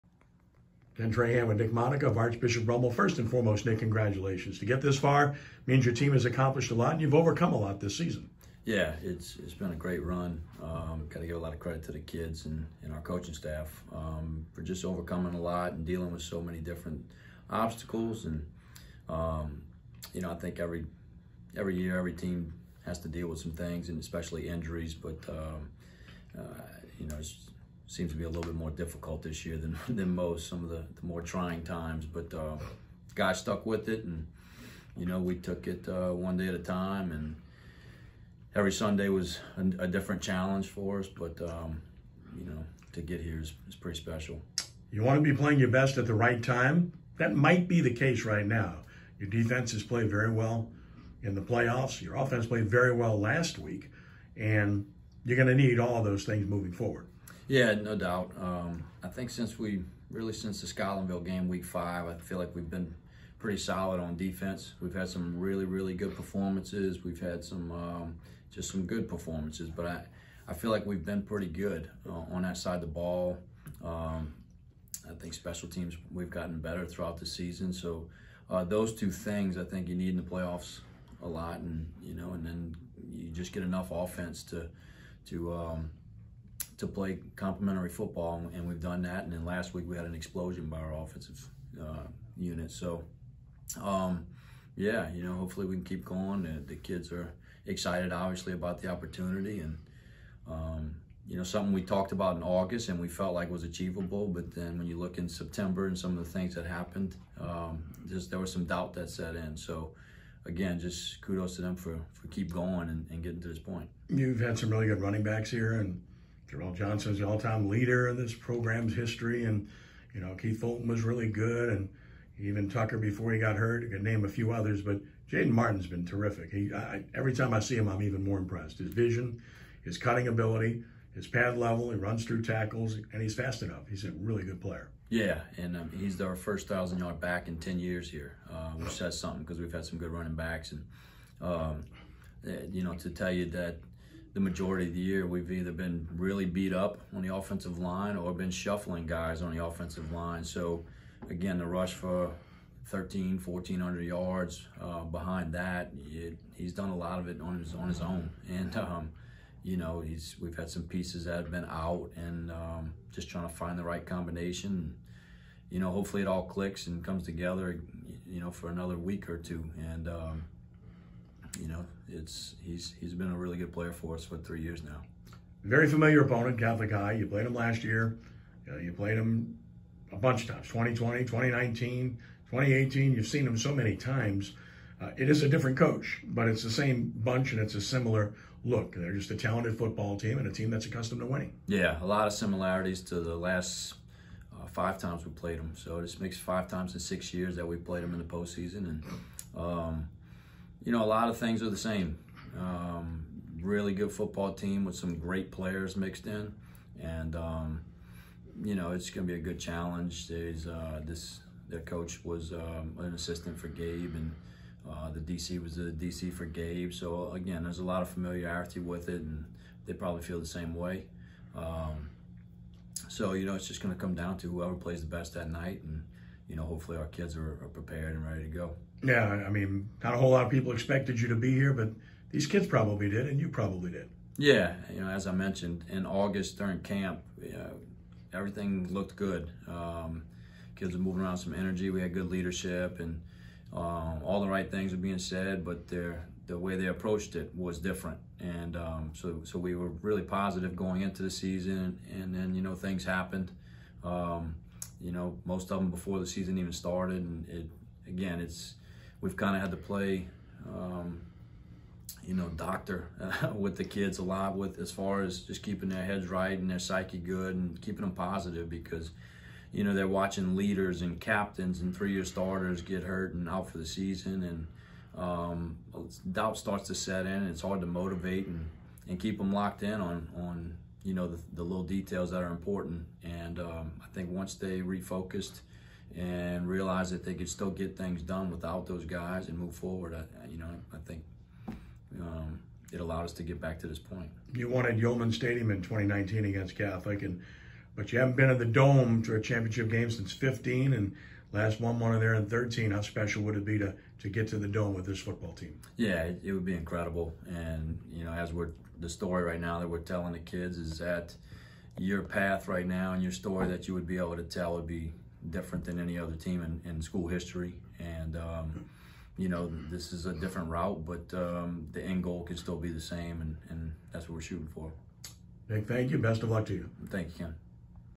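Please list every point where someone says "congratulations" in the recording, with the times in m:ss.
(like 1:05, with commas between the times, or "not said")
0:03.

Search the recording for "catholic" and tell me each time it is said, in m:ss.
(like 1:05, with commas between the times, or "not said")
2:56, 4:56.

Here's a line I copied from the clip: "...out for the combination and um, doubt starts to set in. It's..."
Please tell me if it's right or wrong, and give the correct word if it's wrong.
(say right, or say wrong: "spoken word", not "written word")
wrong: "season", not "combination".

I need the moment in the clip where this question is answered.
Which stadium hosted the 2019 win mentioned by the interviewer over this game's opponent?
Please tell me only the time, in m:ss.
4:54.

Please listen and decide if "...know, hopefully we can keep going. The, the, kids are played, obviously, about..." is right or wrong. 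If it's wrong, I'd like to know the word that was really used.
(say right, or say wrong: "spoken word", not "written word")
wrong: "excited", not "played".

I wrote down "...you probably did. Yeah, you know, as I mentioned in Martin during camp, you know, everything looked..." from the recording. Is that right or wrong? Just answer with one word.
wrong.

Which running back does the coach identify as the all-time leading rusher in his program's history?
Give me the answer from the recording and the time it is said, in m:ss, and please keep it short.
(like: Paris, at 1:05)
Darrell Johnson, at 1:56.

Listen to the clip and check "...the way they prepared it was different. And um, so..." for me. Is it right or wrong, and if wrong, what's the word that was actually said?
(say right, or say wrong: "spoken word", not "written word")
wrong: "approached", not "prepared".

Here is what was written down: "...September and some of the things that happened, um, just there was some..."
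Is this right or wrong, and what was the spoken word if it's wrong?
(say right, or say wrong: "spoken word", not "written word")
right.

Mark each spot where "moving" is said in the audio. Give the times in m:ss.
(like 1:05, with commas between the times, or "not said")
0:56, 4:01.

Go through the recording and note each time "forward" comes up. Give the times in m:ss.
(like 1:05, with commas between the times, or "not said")
0:56, 4:49.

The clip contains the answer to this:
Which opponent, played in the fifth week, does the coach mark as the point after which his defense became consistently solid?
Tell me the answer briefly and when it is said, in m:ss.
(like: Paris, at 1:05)
Scotlandville, at 1:00.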